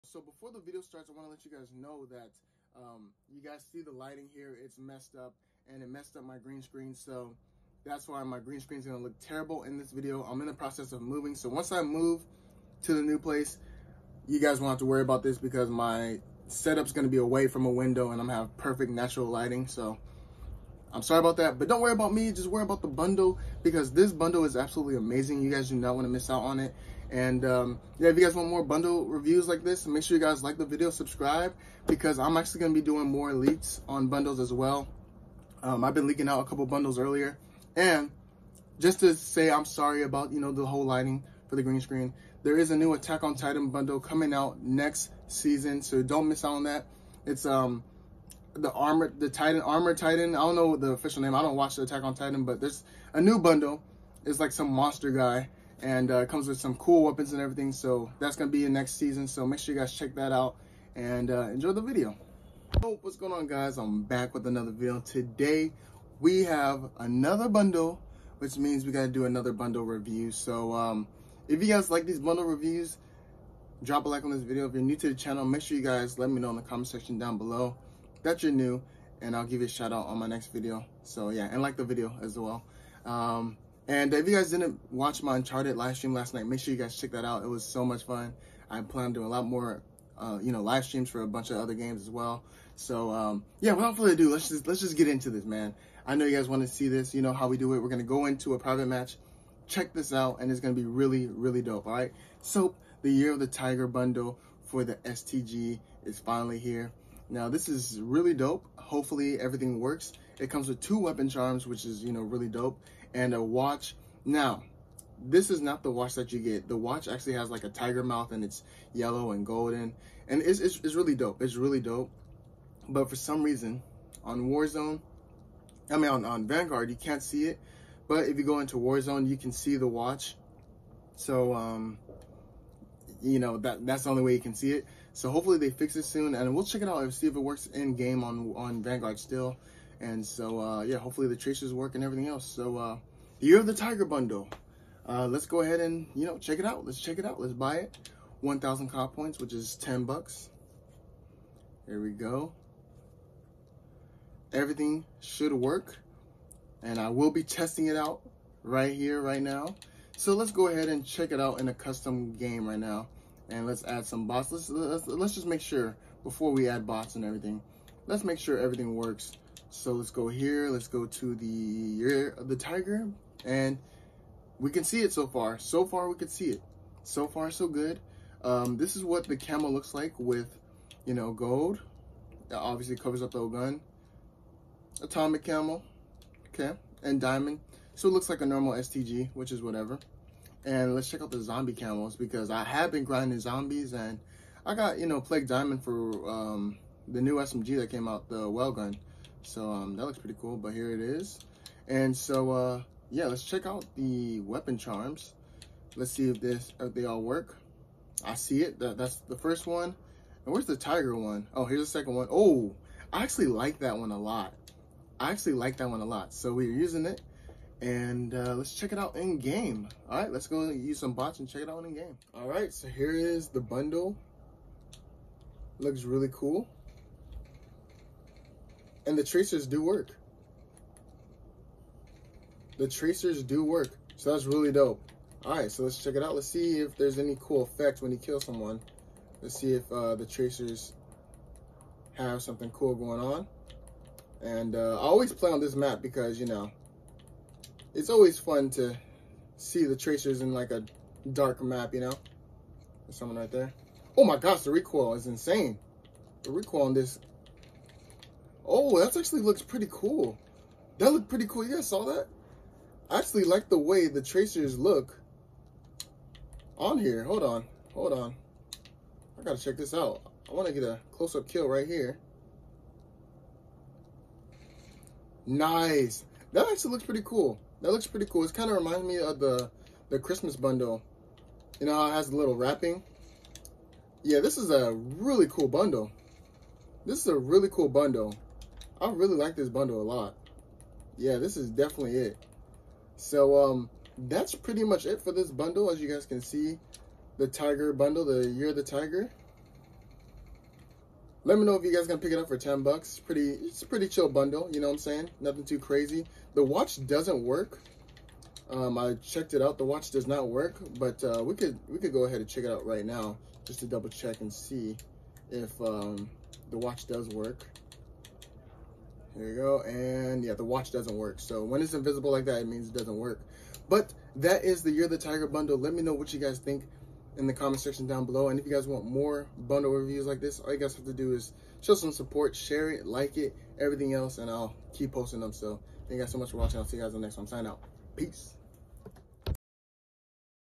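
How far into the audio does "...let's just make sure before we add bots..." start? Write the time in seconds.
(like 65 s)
165 s.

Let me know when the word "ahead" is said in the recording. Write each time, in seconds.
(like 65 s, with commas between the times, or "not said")
145 s, 160 s, 312 s.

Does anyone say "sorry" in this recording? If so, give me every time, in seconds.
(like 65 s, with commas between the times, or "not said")
21 s, 39 s.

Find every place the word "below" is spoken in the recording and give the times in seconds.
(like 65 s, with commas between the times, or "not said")
77 s, 328 s.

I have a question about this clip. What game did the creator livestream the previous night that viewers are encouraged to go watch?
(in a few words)
Uncharted.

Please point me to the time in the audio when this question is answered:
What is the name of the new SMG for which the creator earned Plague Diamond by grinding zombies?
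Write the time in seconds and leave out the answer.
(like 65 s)
198 s.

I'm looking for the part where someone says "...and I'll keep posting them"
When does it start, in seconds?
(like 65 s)
334 s.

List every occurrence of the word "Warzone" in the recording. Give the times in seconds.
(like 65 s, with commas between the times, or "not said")
124 s, 128 s.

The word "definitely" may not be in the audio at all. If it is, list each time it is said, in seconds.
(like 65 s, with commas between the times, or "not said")
291 s.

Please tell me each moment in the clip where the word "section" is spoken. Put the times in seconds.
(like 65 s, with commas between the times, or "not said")
76 s, 327 s.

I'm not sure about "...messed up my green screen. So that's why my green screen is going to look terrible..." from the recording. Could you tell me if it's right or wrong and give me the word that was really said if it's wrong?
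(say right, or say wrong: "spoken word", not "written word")
right.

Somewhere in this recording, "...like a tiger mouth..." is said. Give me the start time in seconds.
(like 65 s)
117 s.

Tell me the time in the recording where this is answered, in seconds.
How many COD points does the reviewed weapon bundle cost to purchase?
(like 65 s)
148 s.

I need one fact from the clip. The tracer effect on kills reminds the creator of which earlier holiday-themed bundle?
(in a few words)
Christmas bundle.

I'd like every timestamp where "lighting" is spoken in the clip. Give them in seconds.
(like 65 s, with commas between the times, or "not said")
3 s, 19 s, 40 s.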